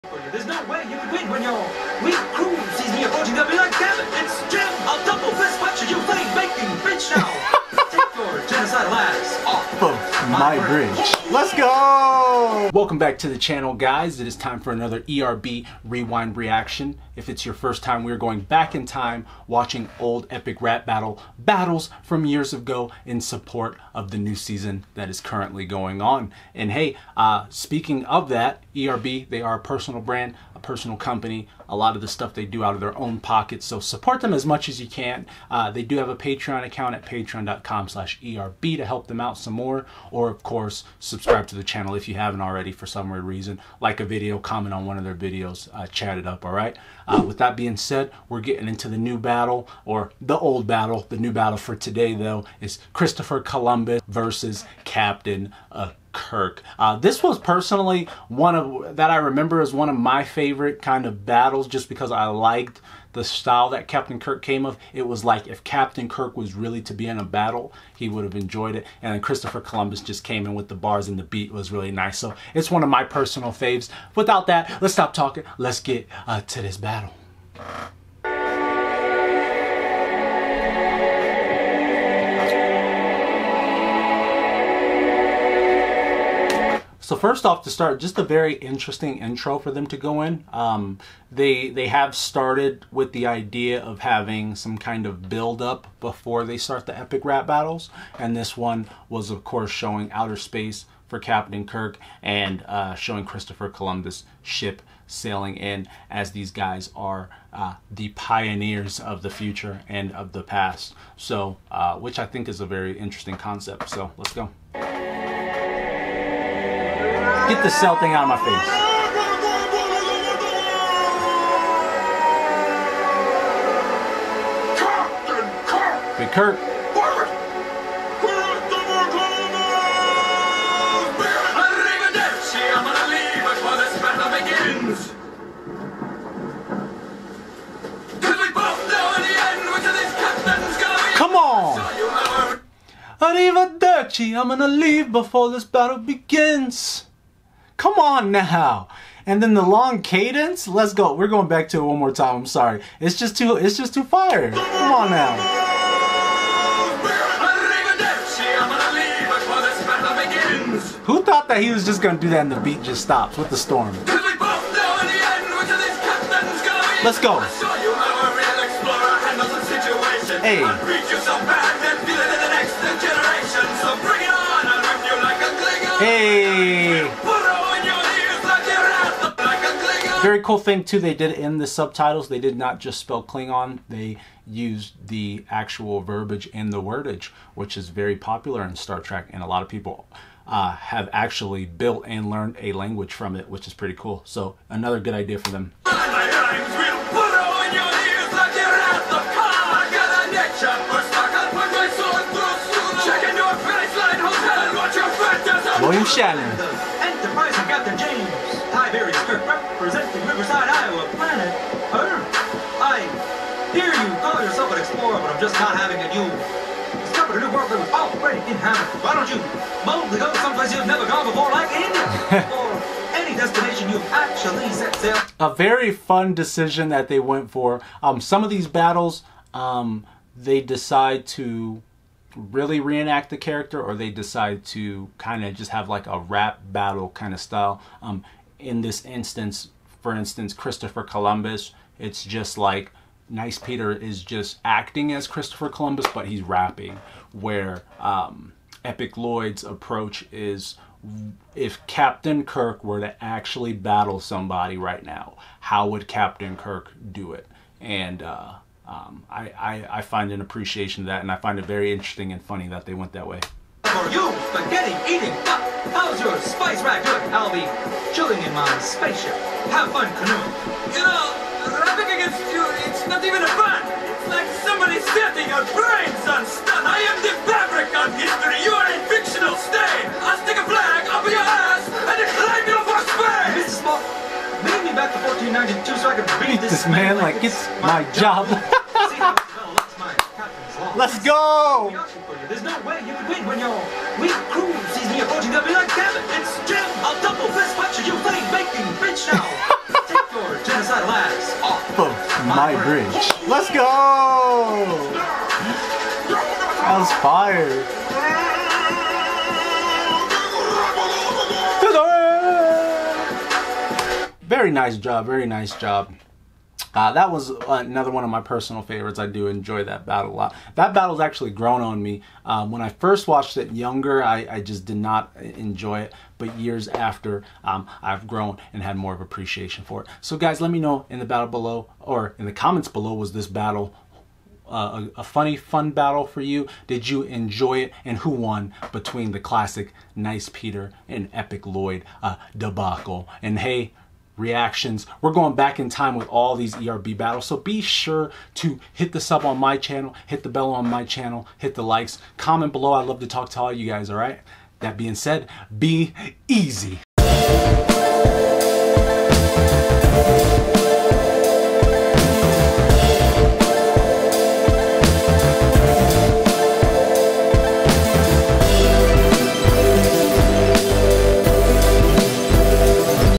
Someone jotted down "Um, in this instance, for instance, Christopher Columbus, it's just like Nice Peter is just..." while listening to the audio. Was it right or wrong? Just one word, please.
right.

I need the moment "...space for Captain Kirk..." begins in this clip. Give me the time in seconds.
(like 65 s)
100 s.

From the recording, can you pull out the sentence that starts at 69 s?
And then Christopher Columbus just came in with the bars and the beat was really nice.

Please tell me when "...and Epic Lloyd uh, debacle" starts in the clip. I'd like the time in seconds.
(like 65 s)
341 s.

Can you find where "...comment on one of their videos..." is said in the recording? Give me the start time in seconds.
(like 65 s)
44 s.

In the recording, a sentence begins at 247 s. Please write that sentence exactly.
Where um, Epic Lloyd's approach is if Captain Kirk were to actually battle somebody right now, how would Captain Kirk do it?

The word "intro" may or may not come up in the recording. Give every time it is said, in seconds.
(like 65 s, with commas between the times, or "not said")
89 s.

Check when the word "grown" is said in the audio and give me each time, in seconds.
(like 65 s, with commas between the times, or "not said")
321 s, 328 s.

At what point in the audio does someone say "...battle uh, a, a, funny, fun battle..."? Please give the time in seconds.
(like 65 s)
333 s.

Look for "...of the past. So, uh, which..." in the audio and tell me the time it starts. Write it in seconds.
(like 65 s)
110 s.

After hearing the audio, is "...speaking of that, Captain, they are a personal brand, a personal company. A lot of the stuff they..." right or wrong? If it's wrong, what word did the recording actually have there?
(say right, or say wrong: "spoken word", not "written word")
wrong: "ERB", not "Captain".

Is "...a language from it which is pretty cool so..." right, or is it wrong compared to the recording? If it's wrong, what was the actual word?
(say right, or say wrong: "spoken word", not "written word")
right.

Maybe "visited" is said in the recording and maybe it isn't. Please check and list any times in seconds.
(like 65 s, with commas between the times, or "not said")
not said.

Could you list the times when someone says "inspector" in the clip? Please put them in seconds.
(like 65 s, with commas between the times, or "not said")
not said.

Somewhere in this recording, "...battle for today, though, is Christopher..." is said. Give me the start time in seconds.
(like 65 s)
51 s.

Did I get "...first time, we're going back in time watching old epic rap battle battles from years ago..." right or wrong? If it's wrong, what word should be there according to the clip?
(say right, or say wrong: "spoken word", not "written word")
right.